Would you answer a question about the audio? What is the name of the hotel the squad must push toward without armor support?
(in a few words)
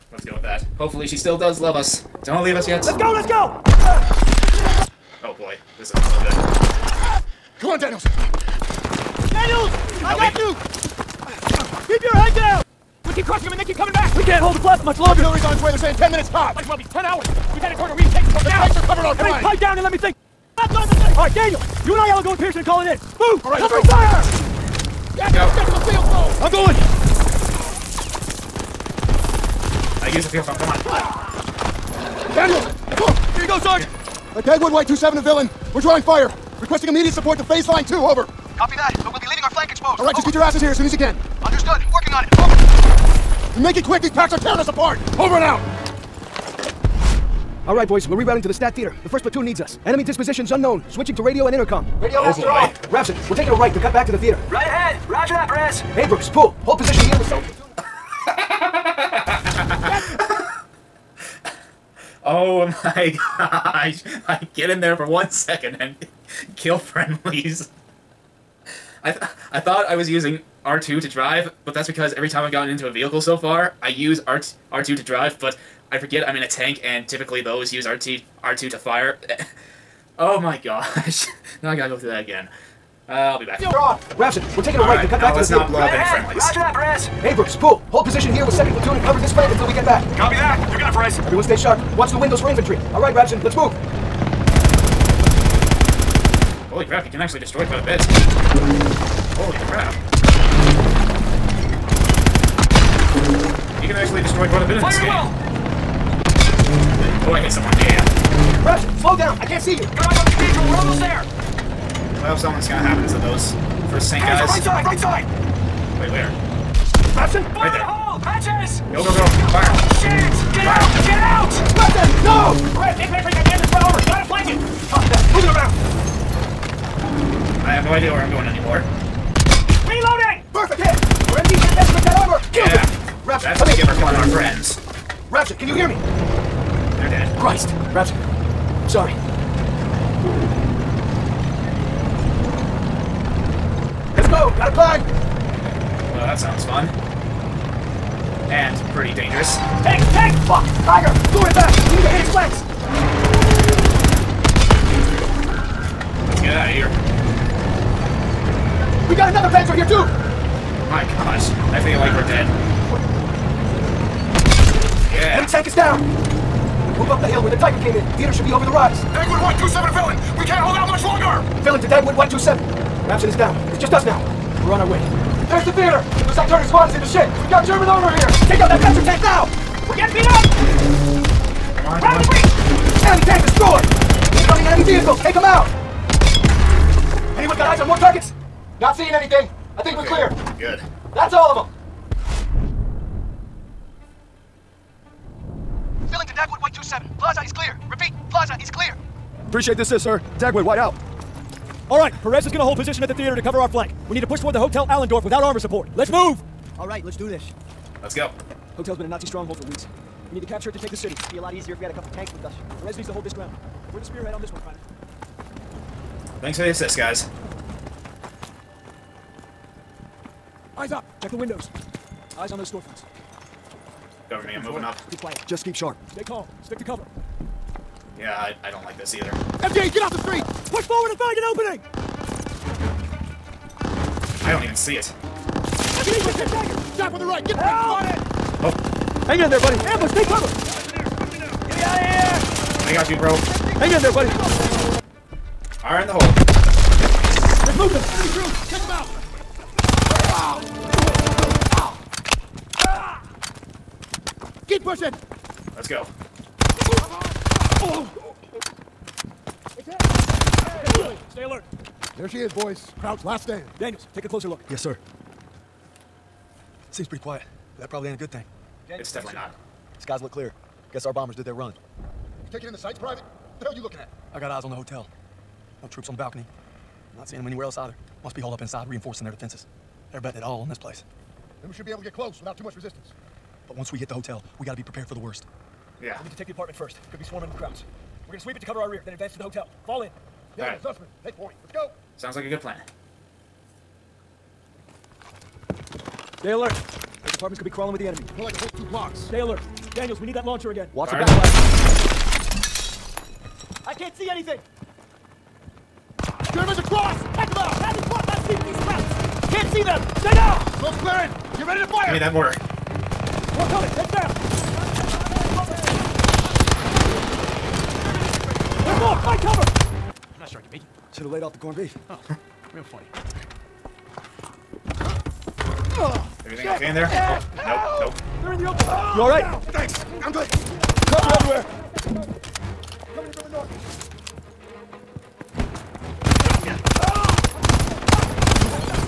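Hotel Allendorf.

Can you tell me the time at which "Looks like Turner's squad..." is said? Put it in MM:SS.
02:56.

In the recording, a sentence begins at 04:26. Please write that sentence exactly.
Seems pretty quiet, but that probably ain't a good thing.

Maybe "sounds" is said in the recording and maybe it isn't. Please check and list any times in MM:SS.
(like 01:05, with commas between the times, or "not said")
02:26, 04:52.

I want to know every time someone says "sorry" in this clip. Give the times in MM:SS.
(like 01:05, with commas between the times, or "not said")
02:18.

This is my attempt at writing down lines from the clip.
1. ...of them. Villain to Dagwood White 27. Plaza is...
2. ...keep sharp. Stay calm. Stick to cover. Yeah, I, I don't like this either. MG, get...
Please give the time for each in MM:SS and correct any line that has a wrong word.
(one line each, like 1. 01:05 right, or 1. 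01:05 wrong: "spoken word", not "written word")
1. 03:11 right
2. 03:45 right.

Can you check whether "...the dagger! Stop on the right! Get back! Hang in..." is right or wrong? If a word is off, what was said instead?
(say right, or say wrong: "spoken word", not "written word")
right.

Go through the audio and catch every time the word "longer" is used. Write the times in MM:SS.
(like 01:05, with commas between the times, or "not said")
00:14, 02:51.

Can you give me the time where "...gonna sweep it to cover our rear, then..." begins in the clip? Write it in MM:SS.
04:48.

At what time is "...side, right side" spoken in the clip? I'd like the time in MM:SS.
01:54.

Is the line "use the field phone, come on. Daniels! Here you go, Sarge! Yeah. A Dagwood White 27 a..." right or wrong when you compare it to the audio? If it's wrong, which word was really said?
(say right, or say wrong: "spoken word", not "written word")
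right.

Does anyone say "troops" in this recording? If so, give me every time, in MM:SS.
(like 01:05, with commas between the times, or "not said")
04:08, 04:35.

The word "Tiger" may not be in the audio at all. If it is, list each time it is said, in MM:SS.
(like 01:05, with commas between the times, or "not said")
02:30, 02:47.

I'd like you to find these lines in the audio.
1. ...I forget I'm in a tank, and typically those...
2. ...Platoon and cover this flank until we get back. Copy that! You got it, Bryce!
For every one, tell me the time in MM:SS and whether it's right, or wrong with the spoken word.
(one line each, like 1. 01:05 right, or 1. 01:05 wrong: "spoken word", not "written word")
1. 01:15 right
2. 01:28 right.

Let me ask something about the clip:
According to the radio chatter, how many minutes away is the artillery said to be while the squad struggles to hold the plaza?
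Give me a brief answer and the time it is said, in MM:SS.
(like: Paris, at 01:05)
10 minutes, at 00:15.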